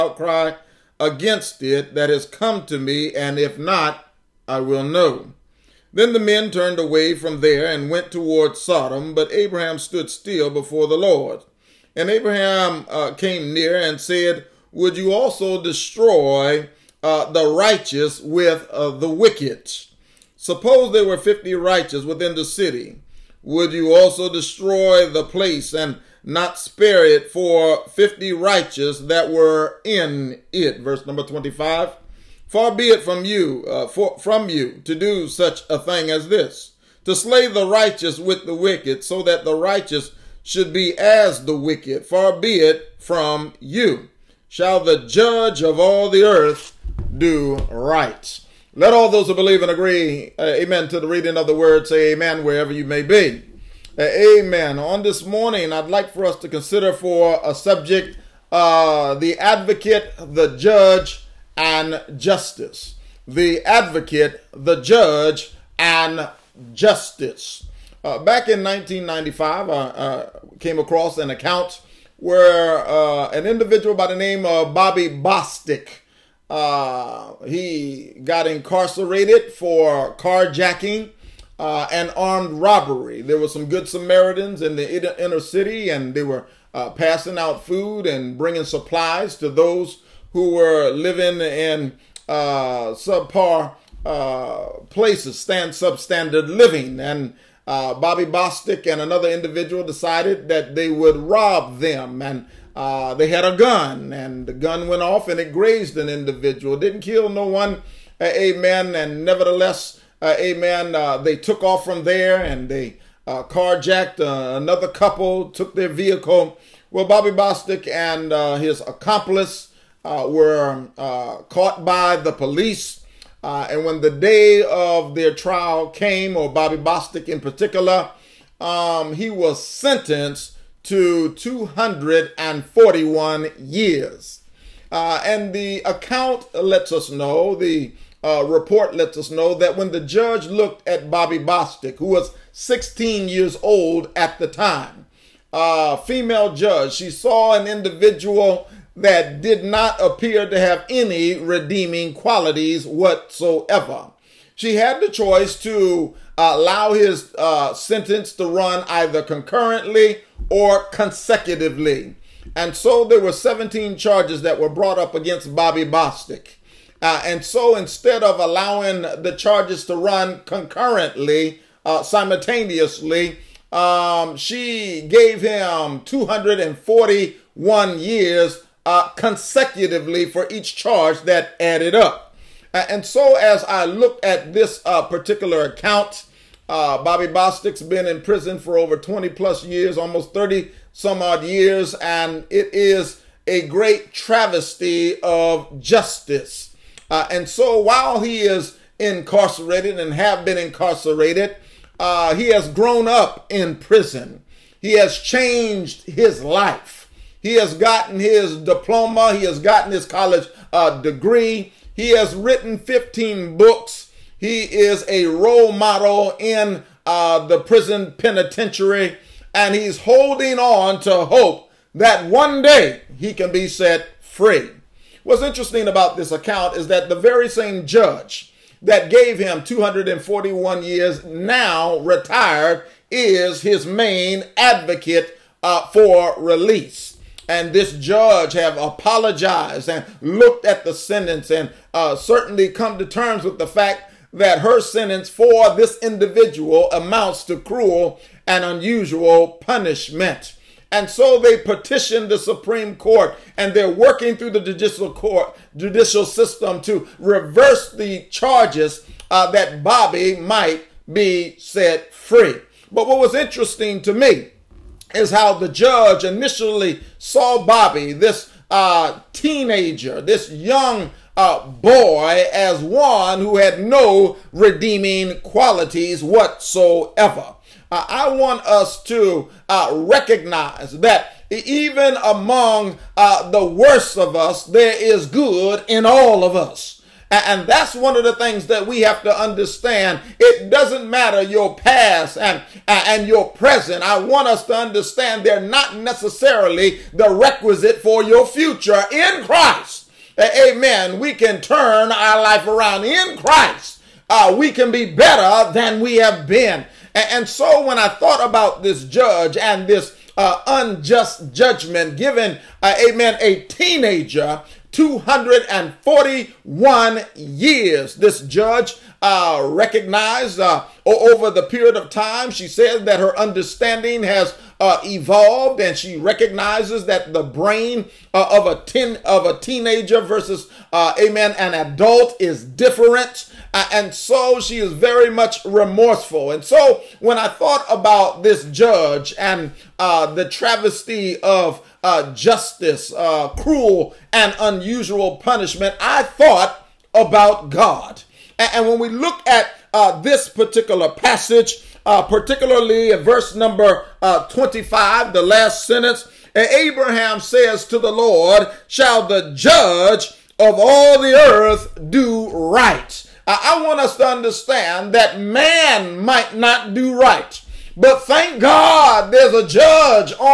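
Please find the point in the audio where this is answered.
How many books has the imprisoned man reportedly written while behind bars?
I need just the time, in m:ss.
3:32.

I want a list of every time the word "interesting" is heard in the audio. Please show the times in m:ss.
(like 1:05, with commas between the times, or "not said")
3:45, 4:23.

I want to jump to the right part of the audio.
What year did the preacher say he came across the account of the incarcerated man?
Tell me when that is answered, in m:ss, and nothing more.
1:08.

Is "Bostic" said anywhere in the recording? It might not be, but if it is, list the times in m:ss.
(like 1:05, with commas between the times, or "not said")
1:15, 1:38, 1:57, 2:06, 2:21, 2:45, 3:07.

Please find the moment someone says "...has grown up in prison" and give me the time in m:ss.
3:22.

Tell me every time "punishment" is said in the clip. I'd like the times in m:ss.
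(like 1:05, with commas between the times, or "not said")
4:09, 5:45.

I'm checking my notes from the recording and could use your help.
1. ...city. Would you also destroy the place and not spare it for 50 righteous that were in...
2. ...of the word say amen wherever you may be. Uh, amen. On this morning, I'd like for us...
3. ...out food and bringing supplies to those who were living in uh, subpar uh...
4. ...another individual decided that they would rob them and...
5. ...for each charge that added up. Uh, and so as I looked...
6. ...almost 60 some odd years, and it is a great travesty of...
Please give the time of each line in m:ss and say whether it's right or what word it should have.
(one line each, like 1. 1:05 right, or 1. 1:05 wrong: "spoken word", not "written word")
1. 0:22 right
2. 0:51 right
3. 1:27 right
4. 1:39 right
5. 3:00 right
6. 3:09 wrong: "30", not "60".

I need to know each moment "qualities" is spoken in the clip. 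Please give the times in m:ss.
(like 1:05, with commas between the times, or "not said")
2:32, 4:35.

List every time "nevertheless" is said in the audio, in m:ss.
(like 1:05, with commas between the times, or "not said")
1:49.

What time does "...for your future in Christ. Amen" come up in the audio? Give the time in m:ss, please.
4:57.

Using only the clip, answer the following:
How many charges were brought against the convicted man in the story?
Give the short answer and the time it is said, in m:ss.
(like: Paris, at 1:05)
17, at 2:43.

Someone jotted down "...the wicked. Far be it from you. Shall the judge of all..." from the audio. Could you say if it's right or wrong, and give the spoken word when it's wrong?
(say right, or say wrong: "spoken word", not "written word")
right.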